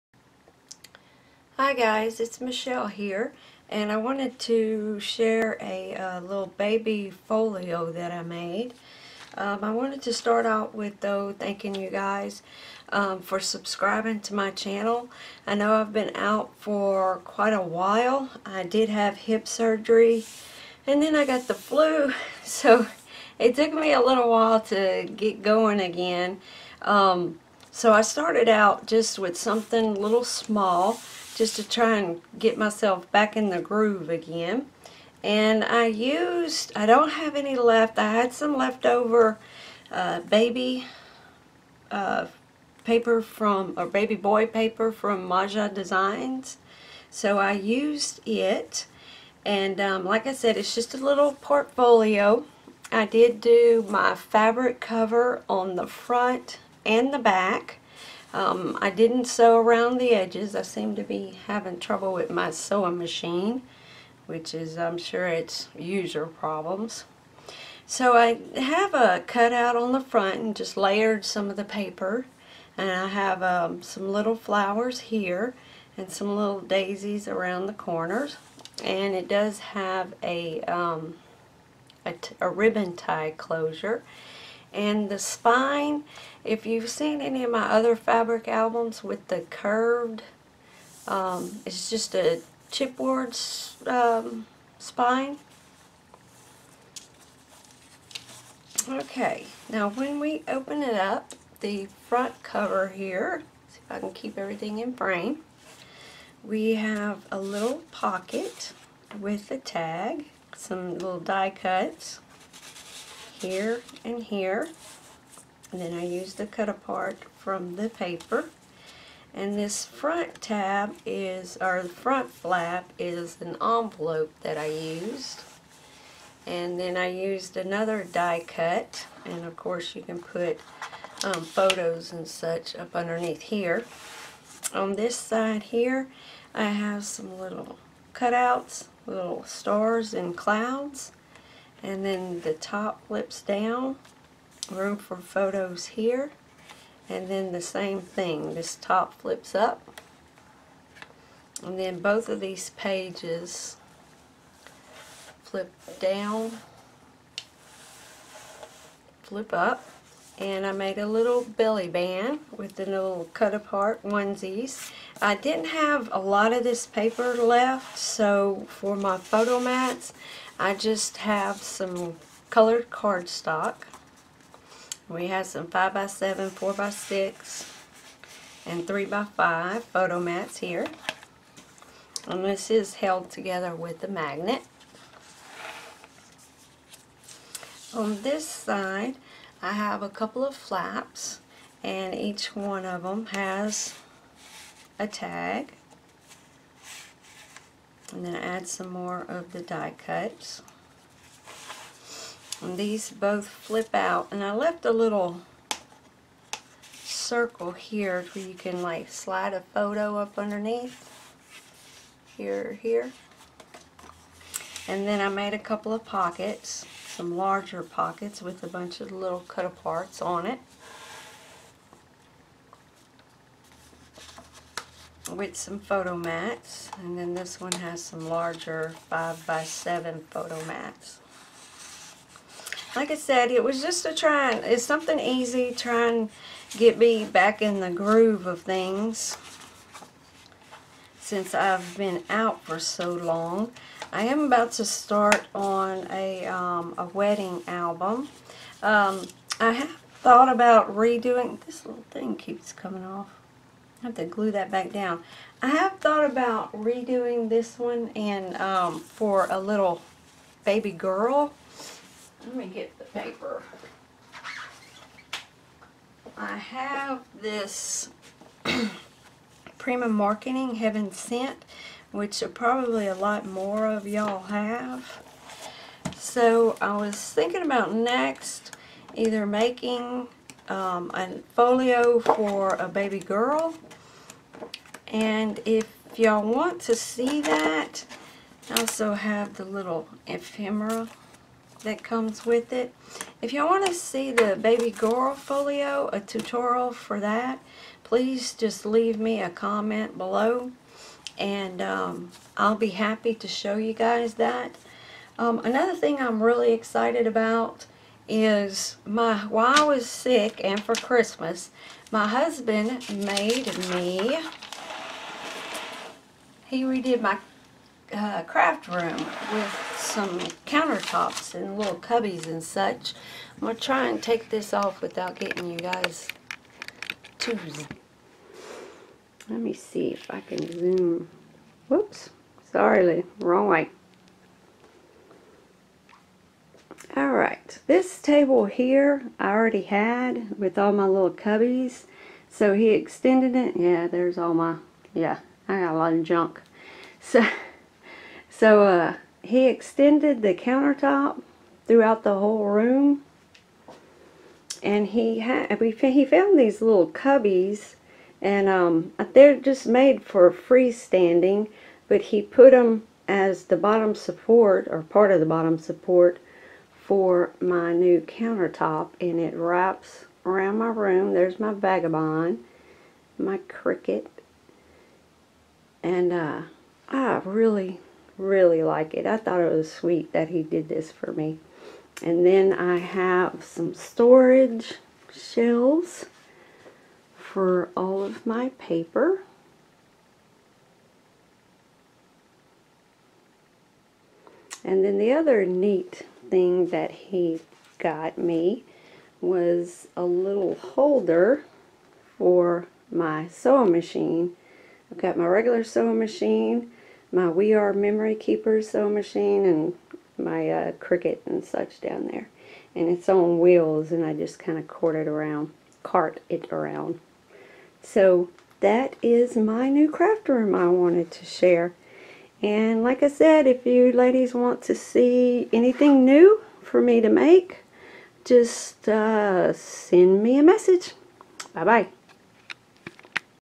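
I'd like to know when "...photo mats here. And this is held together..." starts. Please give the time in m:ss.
2:59.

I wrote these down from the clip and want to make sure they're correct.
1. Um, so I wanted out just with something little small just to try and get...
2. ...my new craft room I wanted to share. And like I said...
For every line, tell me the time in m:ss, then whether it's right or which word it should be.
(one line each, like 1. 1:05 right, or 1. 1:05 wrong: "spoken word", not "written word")
1. 0:26 wrong: "started", not "wanted"
2. 6:59 right.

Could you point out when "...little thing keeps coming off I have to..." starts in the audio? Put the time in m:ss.
4:11.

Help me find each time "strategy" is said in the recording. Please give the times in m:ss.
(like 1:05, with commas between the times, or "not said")
not said.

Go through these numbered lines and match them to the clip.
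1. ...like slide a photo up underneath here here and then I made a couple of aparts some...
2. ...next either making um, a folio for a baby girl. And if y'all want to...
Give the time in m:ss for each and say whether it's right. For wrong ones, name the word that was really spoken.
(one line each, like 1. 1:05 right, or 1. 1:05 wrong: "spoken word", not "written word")
1. 3:28 wrong: "pockets", not "aparts"
2. 4:37 right.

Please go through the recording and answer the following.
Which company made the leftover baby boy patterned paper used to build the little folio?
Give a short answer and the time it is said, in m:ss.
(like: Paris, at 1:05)
Maja Designs, at 0:45.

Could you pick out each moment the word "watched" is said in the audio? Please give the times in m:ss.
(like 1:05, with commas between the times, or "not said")
not said.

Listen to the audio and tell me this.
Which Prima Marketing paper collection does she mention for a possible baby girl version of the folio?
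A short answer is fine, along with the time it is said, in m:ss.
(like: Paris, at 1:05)
Heaven Scent, at 4:30.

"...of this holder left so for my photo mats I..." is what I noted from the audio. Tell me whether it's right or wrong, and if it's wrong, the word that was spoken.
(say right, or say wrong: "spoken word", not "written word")
wrong: "paper", not "holder".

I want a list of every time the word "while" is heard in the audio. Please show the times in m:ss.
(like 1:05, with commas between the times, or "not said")
0:17, 0:24, 5:09.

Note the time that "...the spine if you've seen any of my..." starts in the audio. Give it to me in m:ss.
1:25.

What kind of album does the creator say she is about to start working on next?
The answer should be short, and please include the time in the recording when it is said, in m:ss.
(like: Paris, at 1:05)
a wedding album, at 4:07.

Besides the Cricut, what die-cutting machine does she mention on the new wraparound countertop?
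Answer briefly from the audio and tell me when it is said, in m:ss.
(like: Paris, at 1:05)
Vagabond, at 6:11.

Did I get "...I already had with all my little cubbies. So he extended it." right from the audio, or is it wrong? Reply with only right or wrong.
right.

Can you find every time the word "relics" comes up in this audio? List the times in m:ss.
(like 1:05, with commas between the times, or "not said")
not said.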